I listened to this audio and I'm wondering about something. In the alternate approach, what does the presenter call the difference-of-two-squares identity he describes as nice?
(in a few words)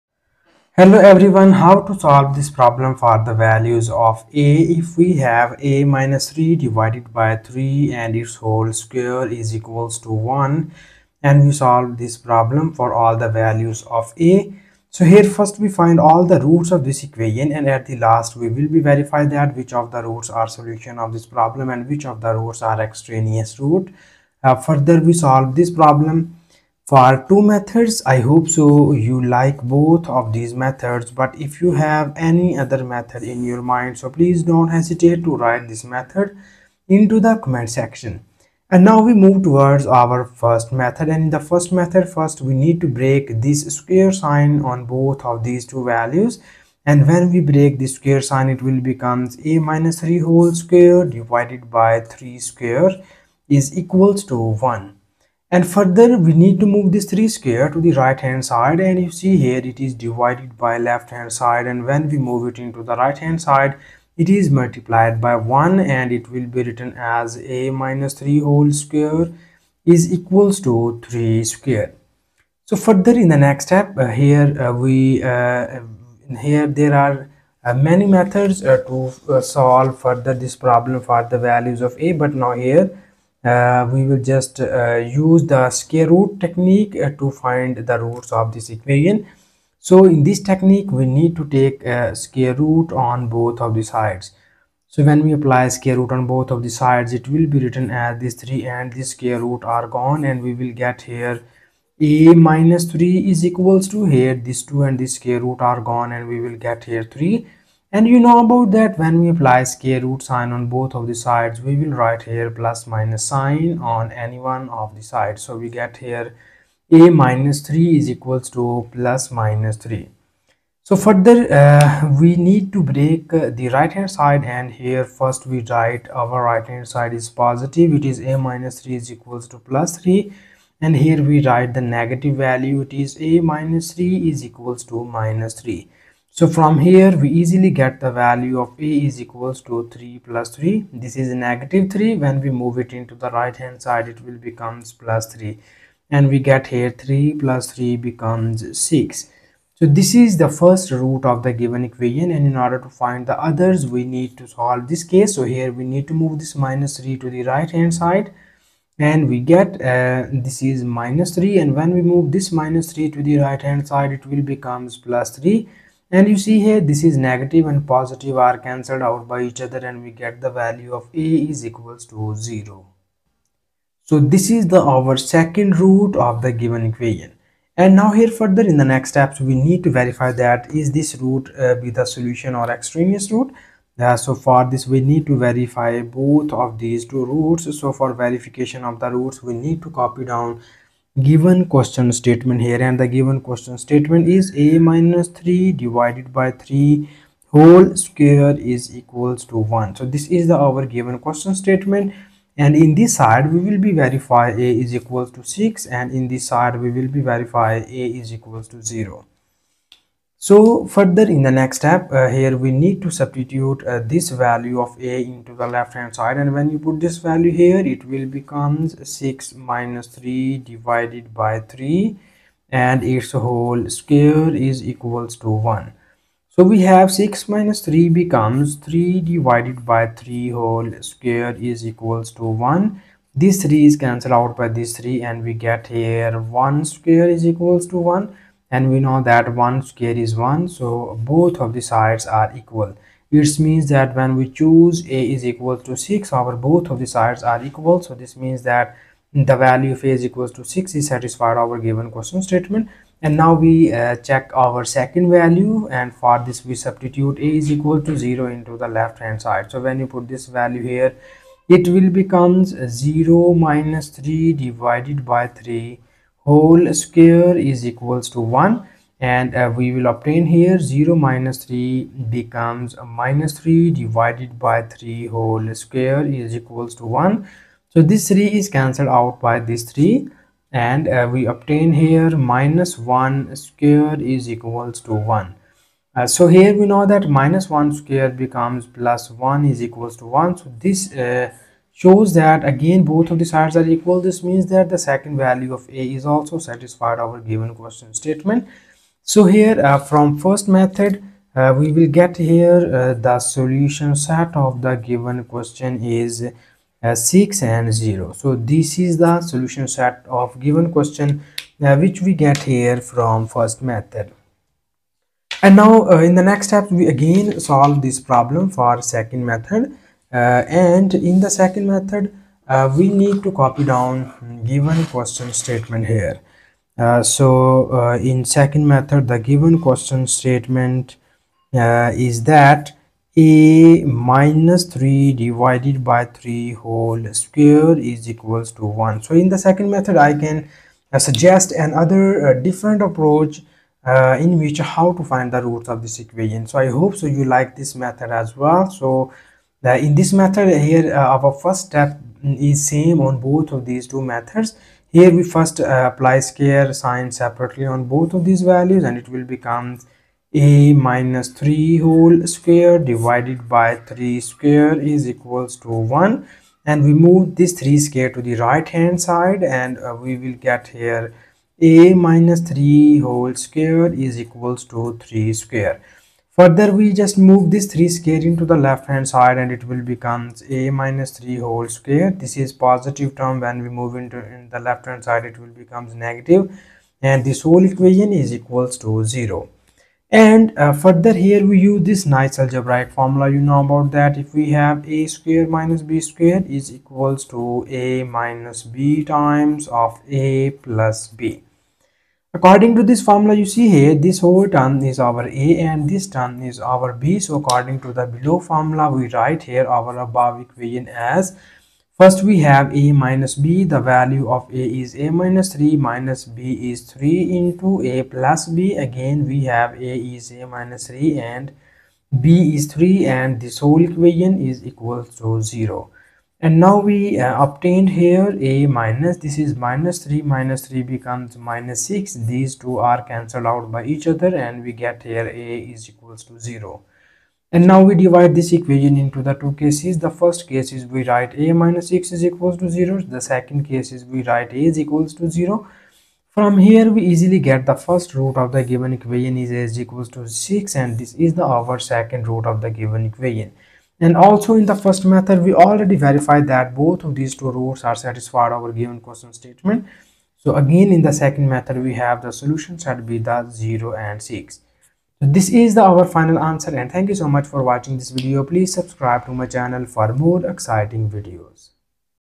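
algebraic formula.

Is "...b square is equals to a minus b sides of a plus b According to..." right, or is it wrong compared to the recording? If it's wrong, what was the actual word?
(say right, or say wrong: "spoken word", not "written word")
wrong: "times", not "sides".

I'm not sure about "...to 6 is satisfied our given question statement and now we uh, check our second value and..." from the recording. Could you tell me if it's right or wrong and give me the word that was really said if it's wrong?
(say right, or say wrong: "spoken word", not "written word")
right.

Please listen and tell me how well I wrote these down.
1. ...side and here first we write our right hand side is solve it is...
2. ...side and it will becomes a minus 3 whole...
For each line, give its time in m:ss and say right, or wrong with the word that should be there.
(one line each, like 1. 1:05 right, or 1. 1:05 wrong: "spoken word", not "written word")
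1. 2:04 wrong: "positive", not "solve"
2. 6:19 right.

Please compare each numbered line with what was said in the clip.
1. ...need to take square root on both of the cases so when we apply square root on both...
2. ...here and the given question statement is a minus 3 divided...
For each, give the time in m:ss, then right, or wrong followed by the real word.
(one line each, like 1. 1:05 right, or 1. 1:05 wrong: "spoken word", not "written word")
1. 1:31 wrong: "sides", not "cases"
2. 3:12 right.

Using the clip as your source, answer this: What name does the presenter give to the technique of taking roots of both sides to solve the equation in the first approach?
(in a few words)
square root technique.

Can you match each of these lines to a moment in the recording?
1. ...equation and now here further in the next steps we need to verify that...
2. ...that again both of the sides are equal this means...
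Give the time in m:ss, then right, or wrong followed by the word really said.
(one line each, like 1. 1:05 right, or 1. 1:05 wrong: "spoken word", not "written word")
1. 2:56 right
2. 4:52 right.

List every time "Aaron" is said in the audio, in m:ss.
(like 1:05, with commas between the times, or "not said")
not said.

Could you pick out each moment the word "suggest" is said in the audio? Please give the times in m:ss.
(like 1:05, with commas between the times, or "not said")
5:41.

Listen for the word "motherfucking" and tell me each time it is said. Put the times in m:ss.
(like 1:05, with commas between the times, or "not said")
not said.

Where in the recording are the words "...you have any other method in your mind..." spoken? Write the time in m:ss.
0:31.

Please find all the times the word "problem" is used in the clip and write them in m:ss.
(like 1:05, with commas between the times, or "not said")
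0:02, 0:12, 0:21, 0:25, 1:20, 5:18.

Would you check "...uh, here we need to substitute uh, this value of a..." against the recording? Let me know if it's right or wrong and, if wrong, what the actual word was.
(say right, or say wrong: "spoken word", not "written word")
right.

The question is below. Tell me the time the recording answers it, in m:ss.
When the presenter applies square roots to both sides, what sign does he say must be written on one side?
1:52.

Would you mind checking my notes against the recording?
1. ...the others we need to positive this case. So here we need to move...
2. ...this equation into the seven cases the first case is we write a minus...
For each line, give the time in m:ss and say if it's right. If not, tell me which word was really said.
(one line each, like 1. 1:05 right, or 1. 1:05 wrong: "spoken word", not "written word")
1. 2:33 wrong: "solve", not "positive"
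2. 7:18 wrong: "two", not "seven".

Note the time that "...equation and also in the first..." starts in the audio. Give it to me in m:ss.
7:33.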